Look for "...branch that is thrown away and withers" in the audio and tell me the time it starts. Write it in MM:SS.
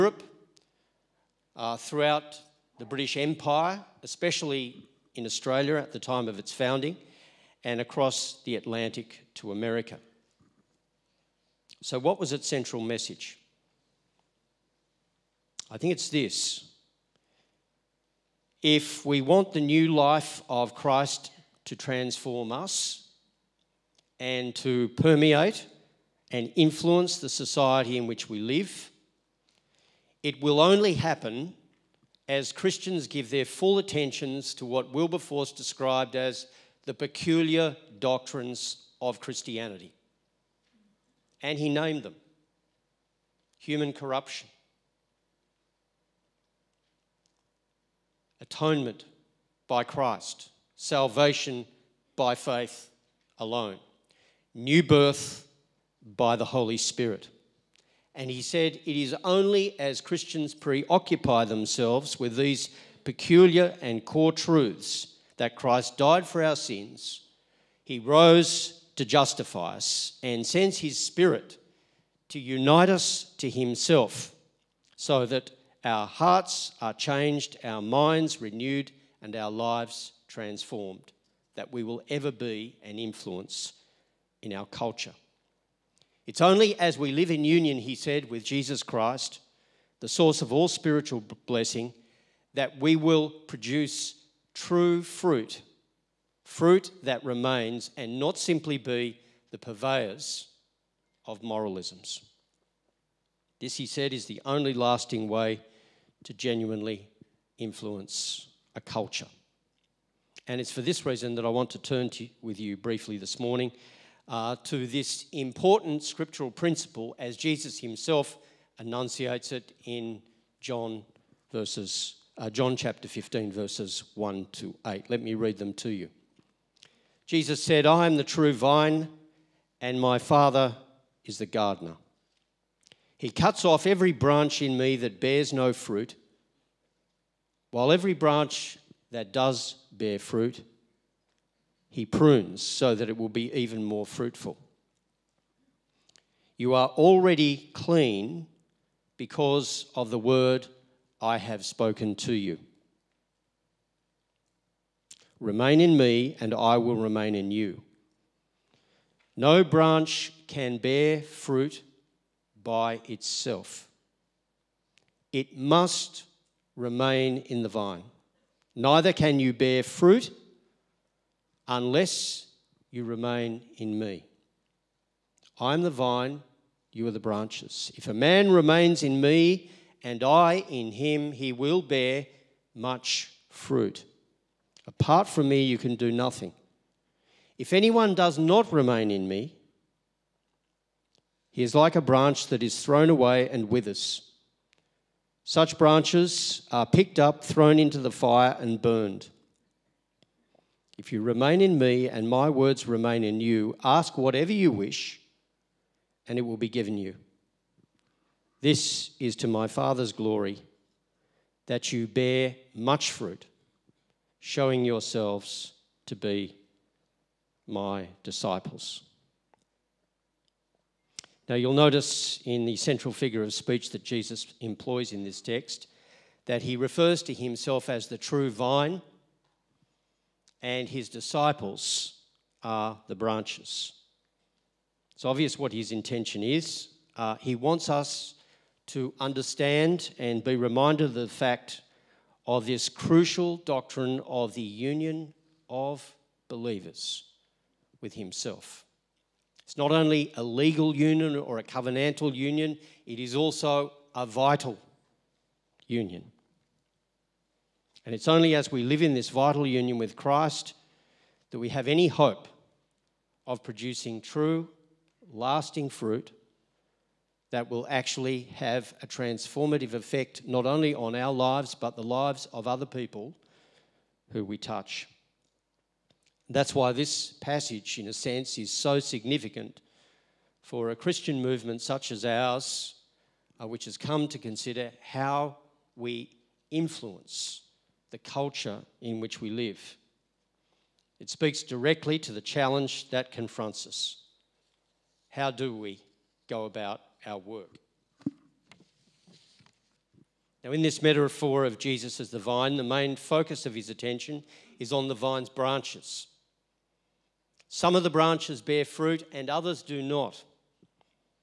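03:12.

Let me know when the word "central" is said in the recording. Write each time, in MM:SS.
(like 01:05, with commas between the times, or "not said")
00:12, 03:42.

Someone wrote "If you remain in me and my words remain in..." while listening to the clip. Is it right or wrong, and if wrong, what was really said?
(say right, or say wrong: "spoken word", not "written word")
right.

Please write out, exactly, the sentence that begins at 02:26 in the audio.
You are already clean because of the word I have spoken to you.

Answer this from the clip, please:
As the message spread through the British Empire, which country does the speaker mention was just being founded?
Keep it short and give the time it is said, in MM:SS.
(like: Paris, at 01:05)
Australia, at 00:05.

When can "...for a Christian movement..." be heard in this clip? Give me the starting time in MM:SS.
04:40.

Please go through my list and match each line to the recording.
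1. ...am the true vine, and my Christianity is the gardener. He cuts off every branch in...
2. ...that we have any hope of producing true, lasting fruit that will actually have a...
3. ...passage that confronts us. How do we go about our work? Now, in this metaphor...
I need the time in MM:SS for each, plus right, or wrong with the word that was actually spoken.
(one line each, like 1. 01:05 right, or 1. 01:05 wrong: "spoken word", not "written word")
1. 02:08 wrong: "Father", not "Christianity"
2. 04:21 right
3. 04:52 wrong: "challenge", not "passage".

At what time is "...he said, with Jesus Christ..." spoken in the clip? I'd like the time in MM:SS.
01:27.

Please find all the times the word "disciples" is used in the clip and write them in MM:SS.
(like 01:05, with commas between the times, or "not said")
03:38, 03:51.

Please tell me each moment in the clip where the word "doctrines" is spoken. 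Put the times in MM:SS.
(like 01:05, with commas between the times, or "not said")
00:37, 04:03.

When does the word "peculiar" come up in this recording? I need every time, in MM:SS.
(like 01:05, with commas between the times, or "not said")
00:36, 01:03.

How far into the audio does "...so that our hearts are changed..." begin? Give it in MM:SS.
01:14.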